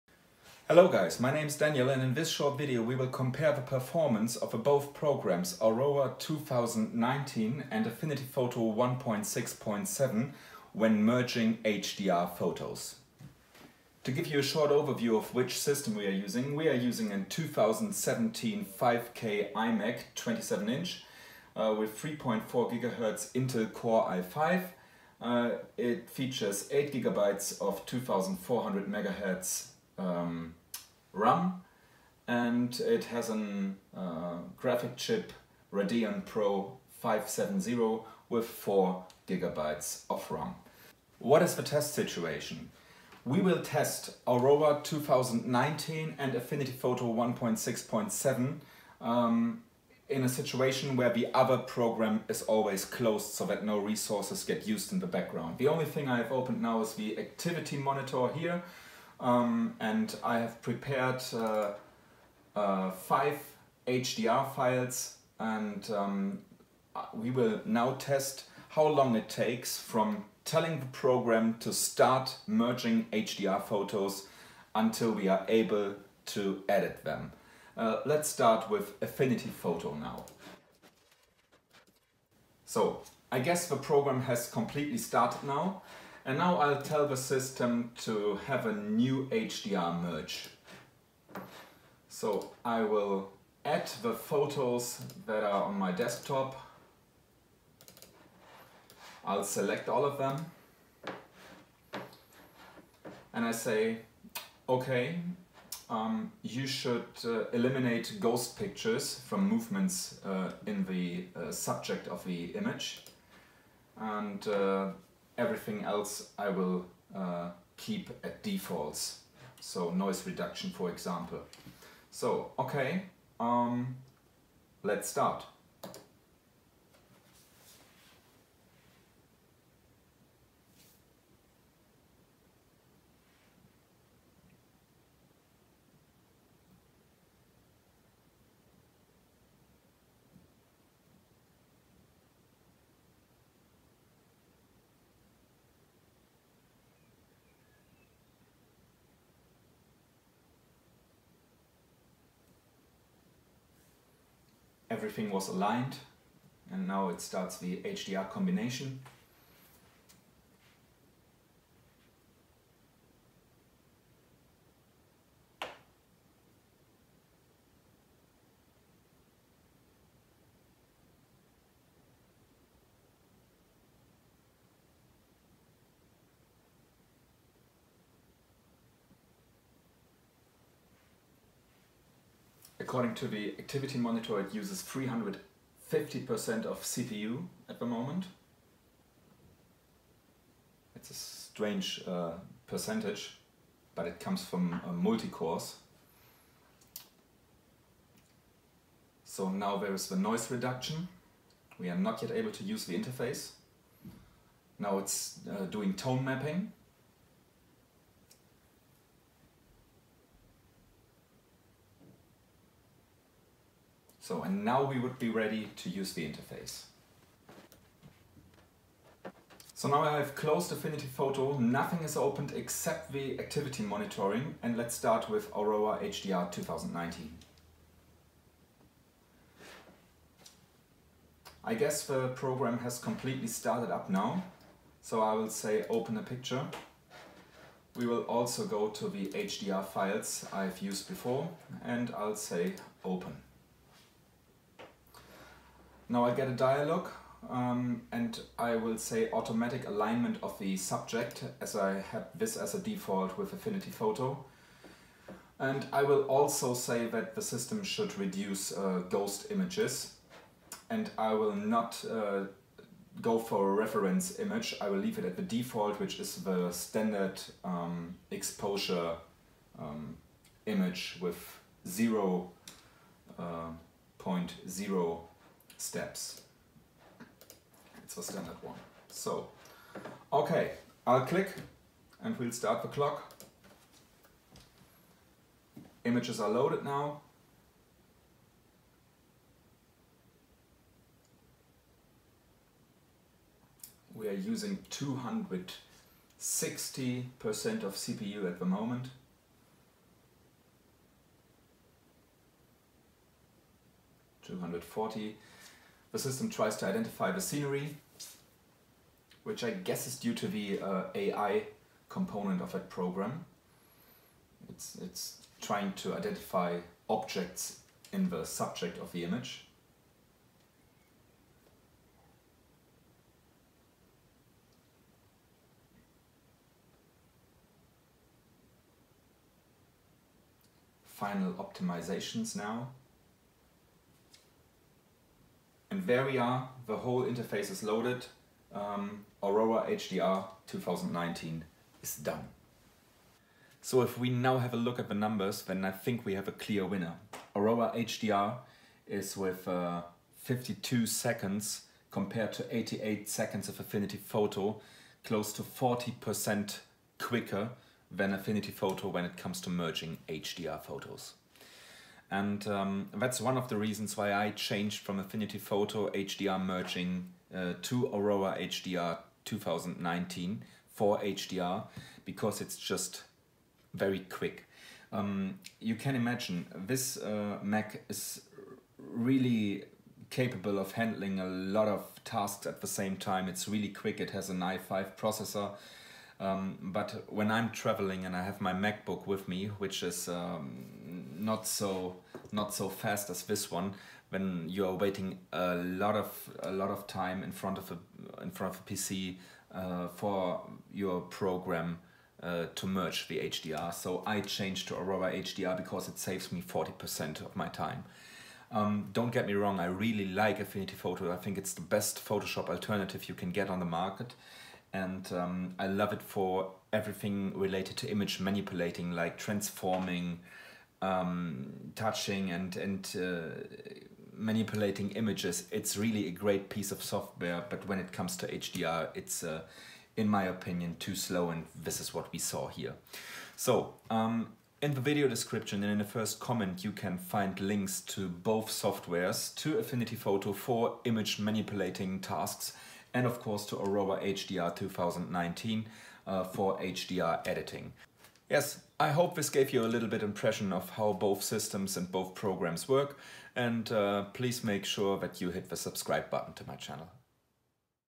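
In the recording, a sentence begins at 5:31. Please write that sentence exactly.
Final optimizations now are, the whole interface is loaded.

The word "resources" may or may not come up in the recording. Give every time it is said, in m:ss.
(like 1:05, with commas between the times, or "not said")
0:53.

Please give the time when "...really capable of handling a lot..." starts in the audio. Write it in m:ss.
6:18.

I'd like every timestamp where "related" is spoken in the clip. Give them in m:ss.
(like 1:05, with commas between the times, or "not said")
6:57.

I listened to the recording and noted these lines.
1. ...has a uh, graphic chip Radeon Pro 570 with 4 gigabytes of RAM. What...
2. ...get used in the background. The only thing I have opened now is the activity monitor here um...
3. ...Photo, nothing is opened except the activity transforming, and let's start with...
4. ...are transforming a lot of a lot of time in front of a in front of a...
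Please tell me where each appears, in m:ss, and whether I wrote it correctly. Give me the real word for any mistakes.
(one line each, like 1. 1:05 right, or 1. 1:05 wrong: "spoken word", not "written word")
1. 0:33 right
2. 0:54 right
3. 3:41 wrong: "monitoring", not "transforming"
4. 6:34 wrong: "waiting", not "transforming".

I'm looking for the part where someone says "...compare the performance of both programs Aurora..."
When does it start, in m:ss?
0:03.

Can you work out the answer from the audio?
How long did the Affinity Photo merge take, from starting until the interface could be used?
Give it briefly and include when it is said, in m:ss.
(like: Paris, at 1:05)
88 seconds, at 5:52.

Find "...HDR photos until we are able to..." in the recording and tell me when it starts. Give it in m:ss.
1:13.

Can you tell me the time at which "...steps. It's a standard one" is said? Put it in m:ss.
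4:35.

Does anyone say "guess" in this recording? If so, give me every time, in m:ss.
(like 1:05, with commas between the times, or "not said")
1:23, 3:51, 5:09.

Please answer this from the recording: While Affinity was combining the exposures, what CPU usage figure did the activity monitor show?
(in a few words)
350%.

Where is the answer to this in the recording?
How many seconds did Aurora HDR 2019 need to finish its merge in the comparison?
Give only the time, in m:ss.
5:50.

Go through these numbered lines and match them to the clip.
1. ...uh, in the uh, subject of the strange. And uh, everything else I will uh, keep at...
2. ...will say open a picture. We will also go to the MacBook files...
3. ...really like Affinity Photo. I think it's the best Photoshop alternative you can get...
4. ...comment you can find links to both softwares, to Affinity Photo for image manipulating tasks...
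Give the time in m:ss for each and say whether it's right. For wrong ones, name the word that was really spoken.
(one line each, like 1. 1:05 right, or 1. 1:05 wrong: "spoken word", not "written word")
1. 1:50 wrong: "image", not "strange"
2. 3:55 wrong: "HDR", not "MacBook"
3. 6:49 right
4. 7:16 right.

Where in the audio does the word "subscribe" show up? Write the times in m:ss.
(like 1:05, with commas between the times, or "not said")
7:35.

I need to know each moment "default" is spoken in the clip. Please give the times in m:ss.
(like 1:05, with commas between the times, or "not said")
1:58, 4:12, 4:25.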